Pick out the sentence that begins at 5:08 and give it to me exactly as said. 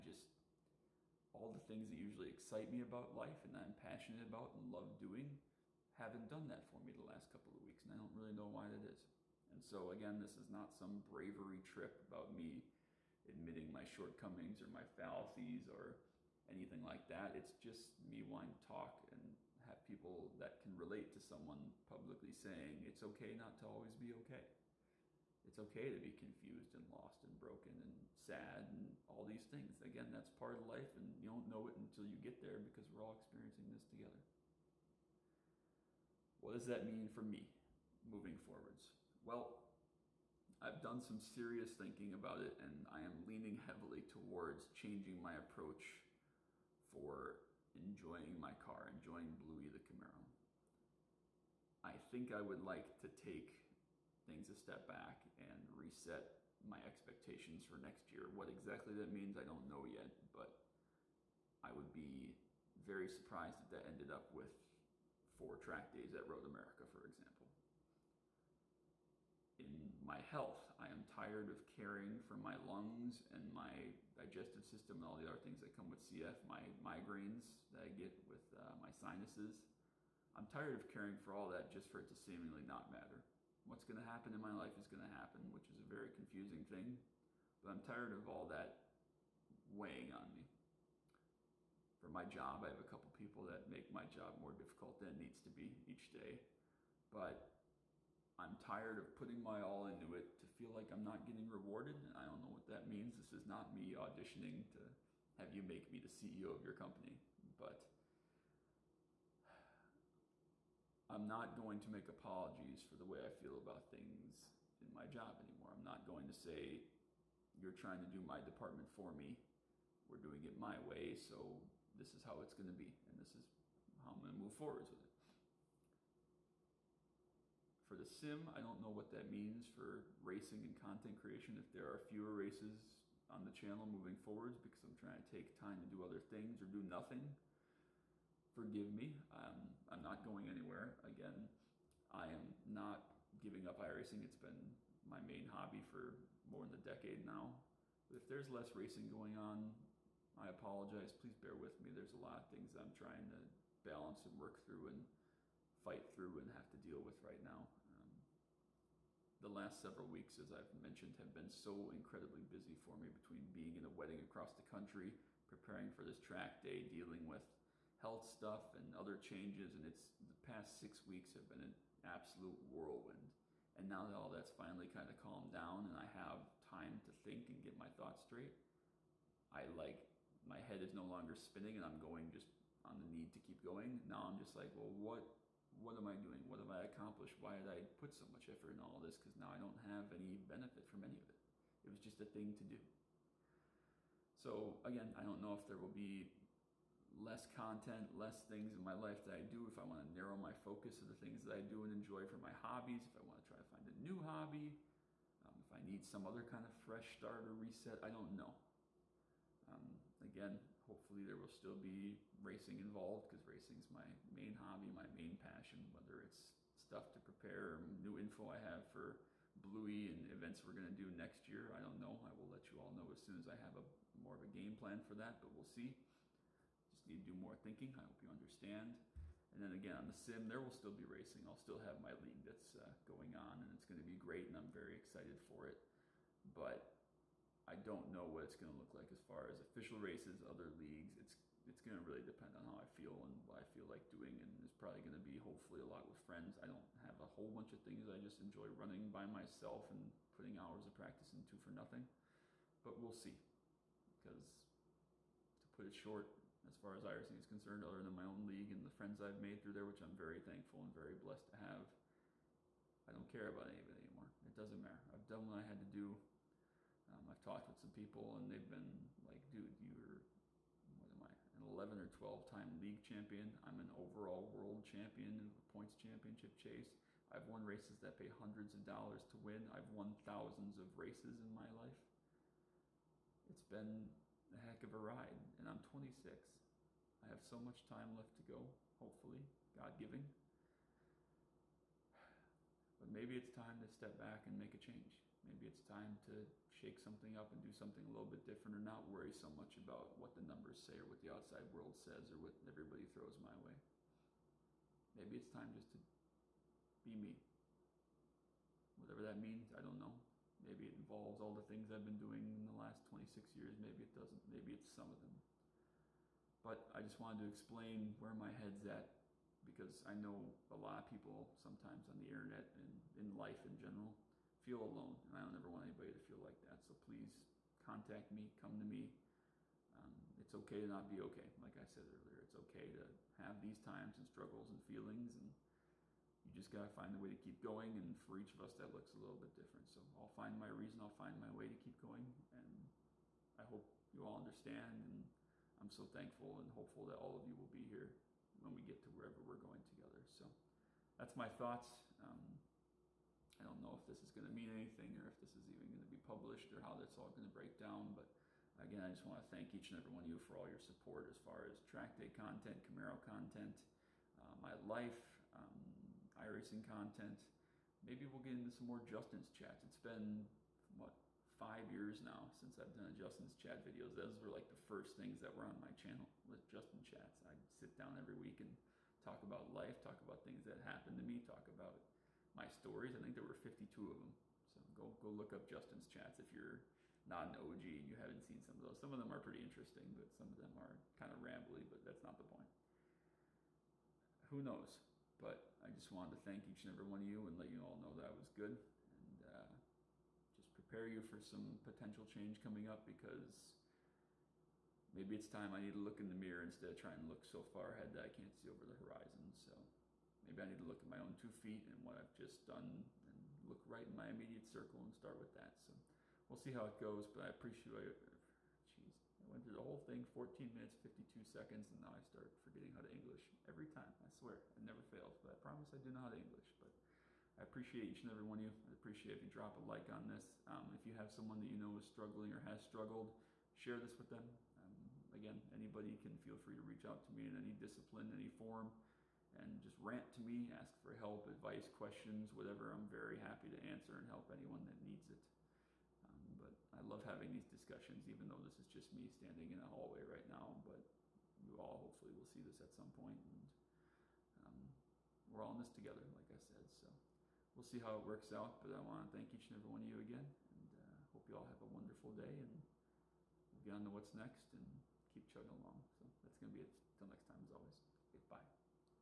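Whatever that means, I don't know.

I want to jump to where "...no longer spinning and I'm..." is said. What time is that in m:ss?
3:00.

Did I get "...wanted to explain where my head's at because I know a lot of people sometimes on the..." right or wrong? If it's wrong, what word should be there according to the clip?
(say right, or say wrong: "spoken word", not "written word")
right.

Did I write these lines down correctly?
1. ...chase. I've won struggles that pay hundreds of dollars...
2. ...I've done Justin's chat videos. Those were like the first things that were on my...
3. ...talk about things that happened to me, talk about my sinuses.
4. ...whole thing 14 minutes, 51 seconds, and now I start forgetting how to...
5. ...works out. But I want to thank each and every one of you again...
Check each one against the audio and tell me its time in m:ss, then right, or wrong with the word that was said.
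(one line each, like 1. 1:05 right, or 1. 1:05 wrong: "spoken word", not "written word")
1. 4:36 wrong: "races", not "struggles"
2. 6:12 right
3. 6:20 wrong: "stories", not "sinuses"
4. 6:59 wrong: "52", not "51"
5. 7:38 right.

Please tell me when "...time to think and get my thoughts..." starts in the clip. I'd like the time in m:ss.
2:56.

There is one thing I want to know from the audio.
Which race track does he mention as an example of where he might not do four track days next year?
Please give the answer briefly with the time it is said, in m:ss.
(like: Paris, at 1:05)
Road America, at 1:06.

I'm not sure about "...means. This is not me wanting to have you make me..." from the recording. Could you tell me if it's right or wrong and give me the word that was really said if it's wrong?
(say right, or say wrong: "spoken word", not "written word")
wrong: "auditioning", not "wanting".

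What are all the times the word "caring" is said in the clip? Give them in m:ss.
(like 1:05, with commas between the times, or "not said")
1:11, 1:20.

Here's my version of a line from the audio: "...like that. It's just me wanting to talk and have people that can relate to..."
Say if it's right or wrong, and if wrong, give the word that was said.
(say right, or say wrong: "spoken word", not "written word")
right.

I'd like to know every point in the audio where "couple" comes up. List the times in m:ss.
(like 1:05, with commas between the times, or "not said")
0:07, 1:32.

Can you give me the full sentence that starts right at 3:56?
But I don't know what it's going to look like as far as official races, other leagues.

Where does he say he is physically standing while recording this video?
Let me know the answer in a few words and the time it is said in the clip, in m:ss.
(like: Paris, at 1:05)
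a hallway, at 7:29.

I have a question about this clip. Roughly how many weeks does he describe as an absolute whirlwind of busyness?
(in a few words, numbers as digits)
6.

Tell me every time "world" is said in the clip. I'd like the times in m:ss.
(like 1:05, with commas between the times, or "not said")
4:34, 5:01.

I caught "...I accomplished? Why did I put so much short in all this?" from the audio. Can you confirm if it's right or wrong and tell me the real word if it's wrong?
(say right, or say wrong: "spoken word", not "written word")
wrong: "effort", not "short".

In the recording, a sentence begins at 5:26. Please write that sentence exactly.
So please contact me, come to me.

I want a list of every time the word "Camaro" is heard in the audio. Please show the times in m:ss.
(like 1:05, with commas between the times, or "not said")
0:49, 6:02.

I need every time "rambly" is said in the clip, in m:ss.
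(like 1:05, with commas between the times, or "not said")
6:31.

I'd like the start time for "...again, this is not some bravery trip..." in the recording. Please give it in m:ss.
0:09.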